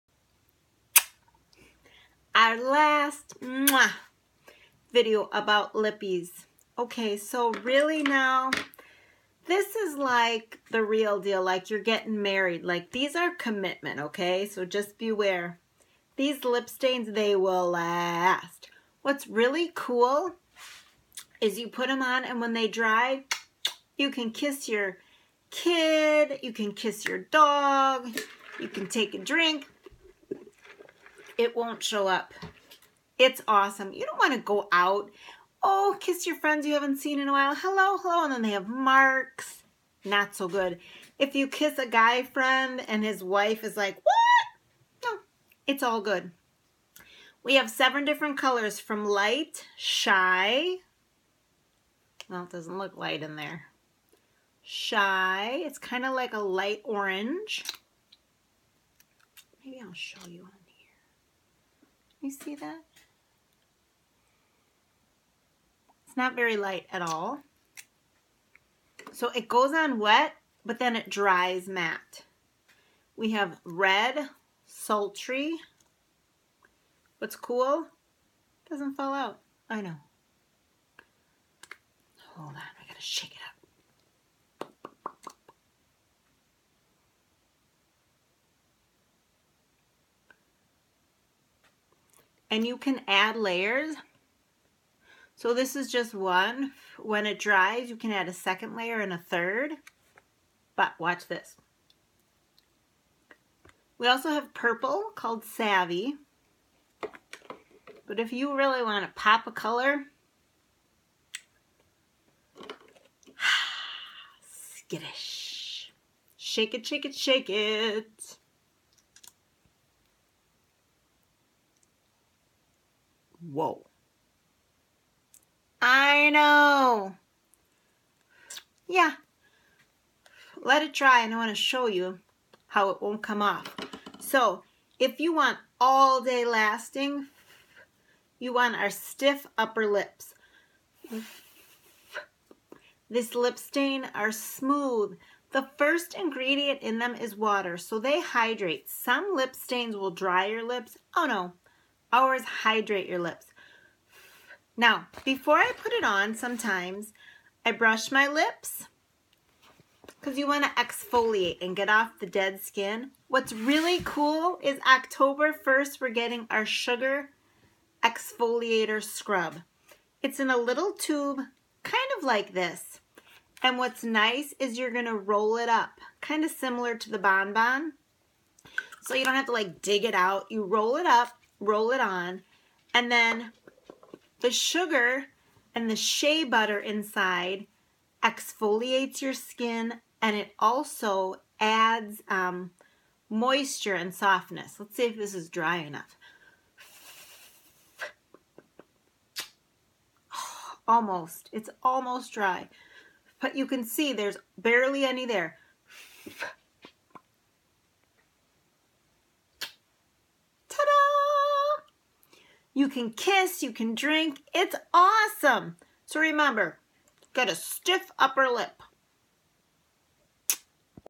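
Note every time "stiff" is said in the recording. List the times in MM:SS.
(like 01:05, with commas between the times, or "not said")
02:18, 03:37.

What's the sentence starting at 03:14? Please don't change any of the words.
Let's see if this is dry enough.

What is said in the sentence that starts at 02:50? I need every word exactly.
It's in a little tube, kind of like this.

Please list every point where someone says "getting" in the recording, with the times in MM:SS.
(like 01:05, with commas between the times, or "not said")
00:11, 02:46.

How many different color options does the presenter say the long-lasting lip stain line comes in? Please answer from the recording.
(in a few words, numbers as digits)
7.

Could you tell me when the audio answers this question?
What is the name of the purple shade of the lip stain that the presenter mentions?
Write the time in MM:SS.
01:45.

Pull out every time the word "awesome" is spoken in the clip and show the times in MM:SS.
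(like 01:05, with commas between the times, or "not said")
00:33, 03:34.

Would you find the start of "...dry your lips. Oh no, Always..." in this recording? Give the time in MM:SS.
02:30.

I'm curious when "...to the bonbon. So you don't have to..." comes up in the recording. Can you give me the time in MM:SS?
02:56.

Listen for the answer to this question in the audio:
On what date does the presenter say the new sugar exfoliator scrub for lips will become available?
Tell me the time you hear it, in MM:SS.
02:44.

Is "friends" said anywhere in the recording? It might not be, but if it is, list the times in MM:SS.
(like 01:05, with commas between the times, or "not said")
00:36, 00:42.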